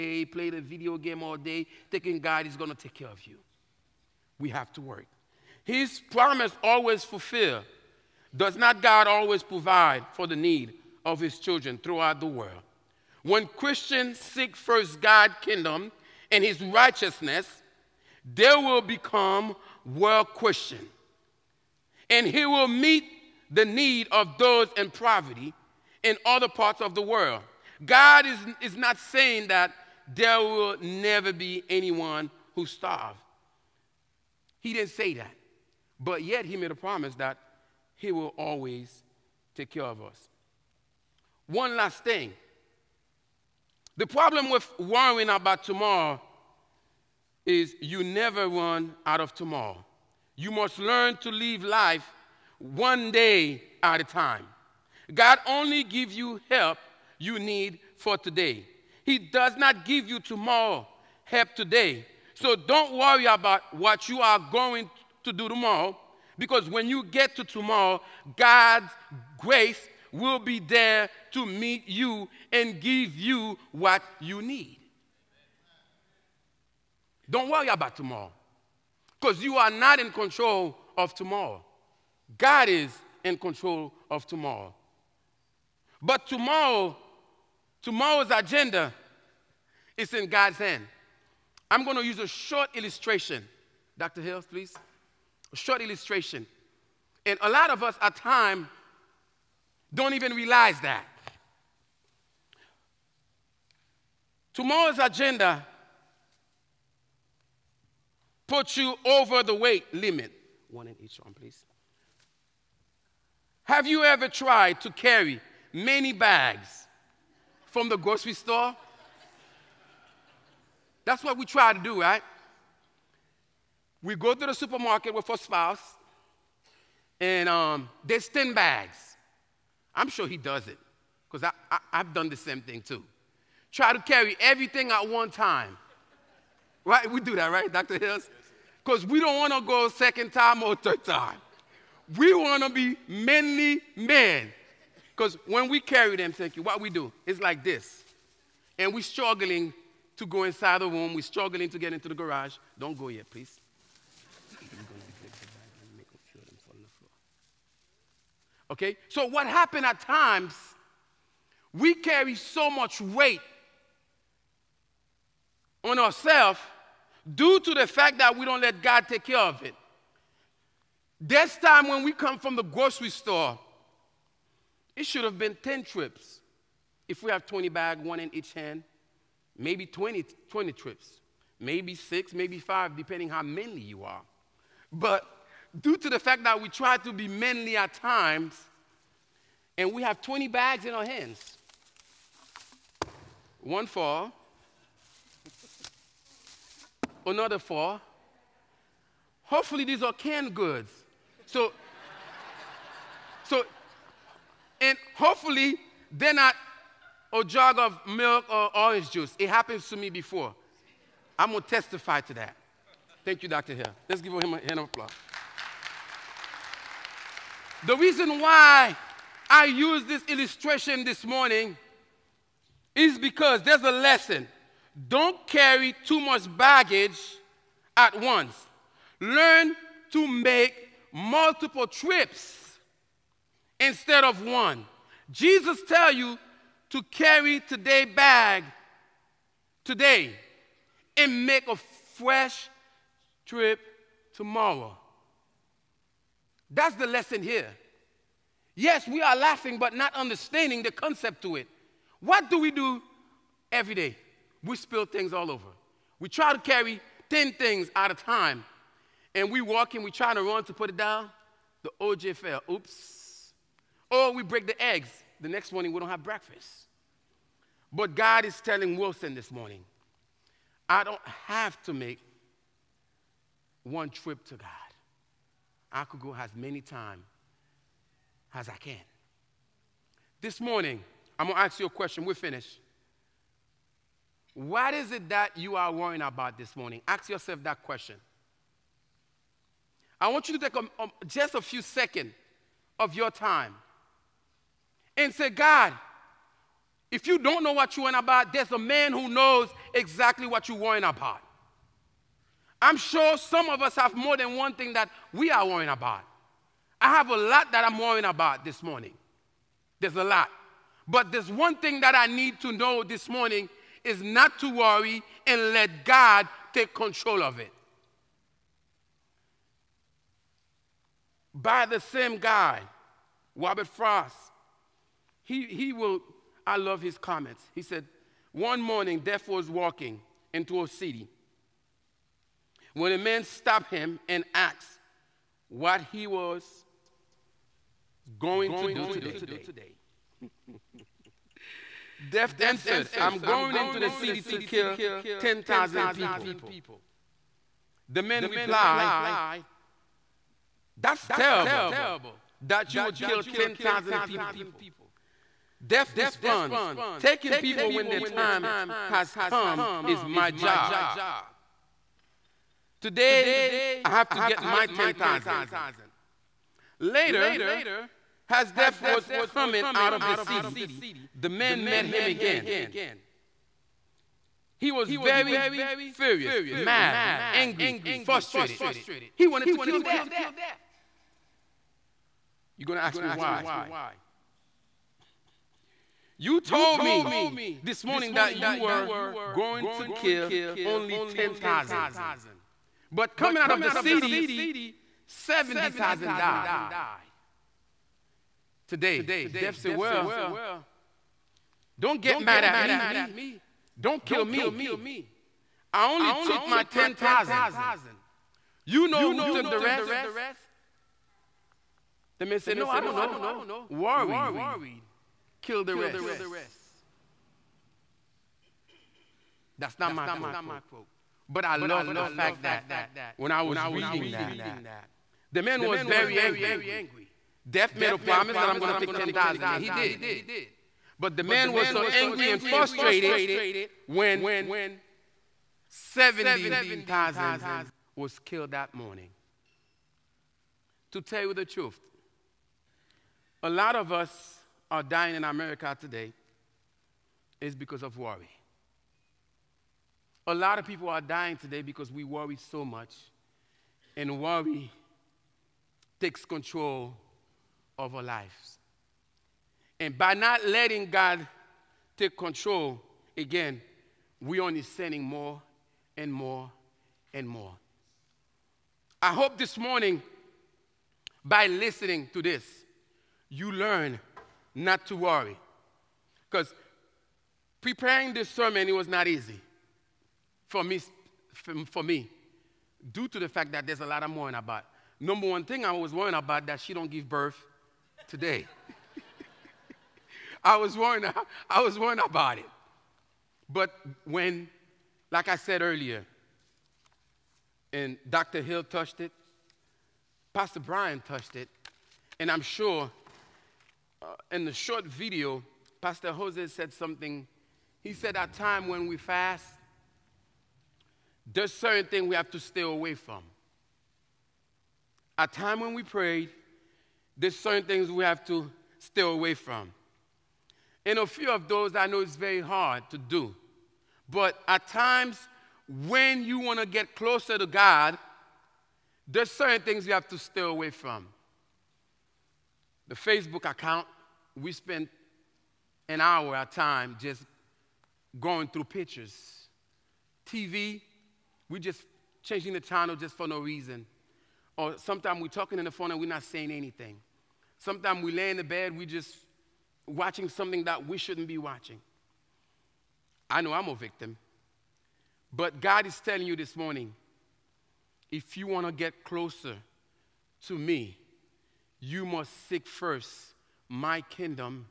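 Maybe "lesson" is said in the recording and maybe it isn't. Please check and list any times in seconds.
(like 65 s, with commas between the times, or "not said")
223 s, 247 s.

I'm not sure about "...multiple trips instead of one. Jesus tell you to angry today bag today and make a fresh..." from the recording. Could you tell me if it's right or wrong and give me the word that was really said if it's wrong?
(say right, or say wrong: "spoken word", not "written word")
wrong: "carry", not "angry".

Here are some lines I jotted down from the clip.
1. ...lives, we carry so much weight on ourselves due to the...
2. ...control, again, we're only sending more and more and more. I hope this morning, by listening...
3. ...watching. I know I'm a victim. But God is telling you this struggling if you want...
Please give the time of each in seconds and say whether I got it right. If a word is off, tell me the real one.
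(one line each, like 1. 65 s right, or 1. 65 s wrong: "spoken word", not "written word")
1. 160 s wrong: "times", not "lives"
2. 462 s right
3. 551 s wrong: "morning", not "struggling".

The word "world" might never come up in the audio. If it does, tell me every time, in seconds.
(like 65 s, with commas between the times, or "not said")
12 s, 19 s, 27 s.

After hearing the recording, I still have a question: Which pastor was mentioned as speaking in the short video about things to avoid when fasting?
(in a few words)
Pastor Jose.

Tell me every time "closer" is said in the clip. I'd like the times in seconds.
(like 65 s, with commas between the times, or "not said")
527 s, 559 s.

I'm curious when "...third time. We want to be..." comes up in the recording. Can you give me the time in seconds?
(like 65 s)
140 s.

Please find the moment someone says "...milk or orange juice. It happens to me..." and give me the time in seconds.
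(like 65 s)
208 s.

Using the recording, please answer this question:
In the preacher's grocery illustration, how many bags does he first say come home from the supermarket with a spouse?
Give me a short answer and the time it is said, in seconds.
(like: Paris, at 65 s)
10, at 128 s.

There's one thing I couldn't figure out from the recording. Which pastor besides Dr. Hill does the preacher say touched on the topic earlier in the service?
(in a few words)
Pastor Brian.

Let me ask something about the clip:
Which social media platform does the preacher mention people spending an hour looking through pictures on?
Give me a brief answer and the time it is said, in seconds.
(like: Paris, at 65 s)
Facebook, at 533 s.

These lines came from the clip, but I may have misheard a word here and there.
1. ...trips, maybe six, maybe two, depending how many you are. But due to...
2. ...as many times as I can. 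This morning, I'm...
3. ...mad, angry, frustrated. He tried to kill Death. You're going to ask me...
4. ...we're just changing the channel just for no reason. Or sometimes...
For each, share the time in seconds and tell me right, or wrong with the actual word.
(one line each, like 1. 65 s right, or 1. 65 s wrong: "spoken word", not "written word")
1. 180 s wrong: "five", not "two"
2. 276 s right
3. 376 s wrong: "wanted", not "tried"
4. 541 s right.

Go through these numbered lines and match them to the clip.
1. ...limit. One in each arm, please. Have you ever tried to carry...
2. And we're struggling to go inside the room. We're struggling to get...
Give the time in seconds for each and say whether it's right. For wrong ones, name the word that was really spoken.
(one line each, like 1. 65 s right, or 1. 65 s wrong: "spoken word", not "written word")
1. 109 s right
2. 148 s right.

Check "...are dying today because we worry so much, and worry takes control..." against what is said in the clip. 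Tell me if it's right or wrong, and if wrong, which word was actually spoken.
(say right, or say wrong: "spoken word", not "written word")
right.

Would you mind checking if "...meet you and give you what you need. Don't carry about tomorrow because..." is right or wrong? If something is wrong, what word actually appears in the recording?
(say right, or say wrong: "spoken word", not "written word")
wrong: "worry", not "carry".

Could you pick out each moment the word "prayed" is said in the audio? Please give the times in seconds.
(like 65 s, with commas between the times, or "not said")
516 s.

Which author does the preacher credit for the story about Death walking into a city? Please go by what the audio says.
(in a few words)
Robert Frost.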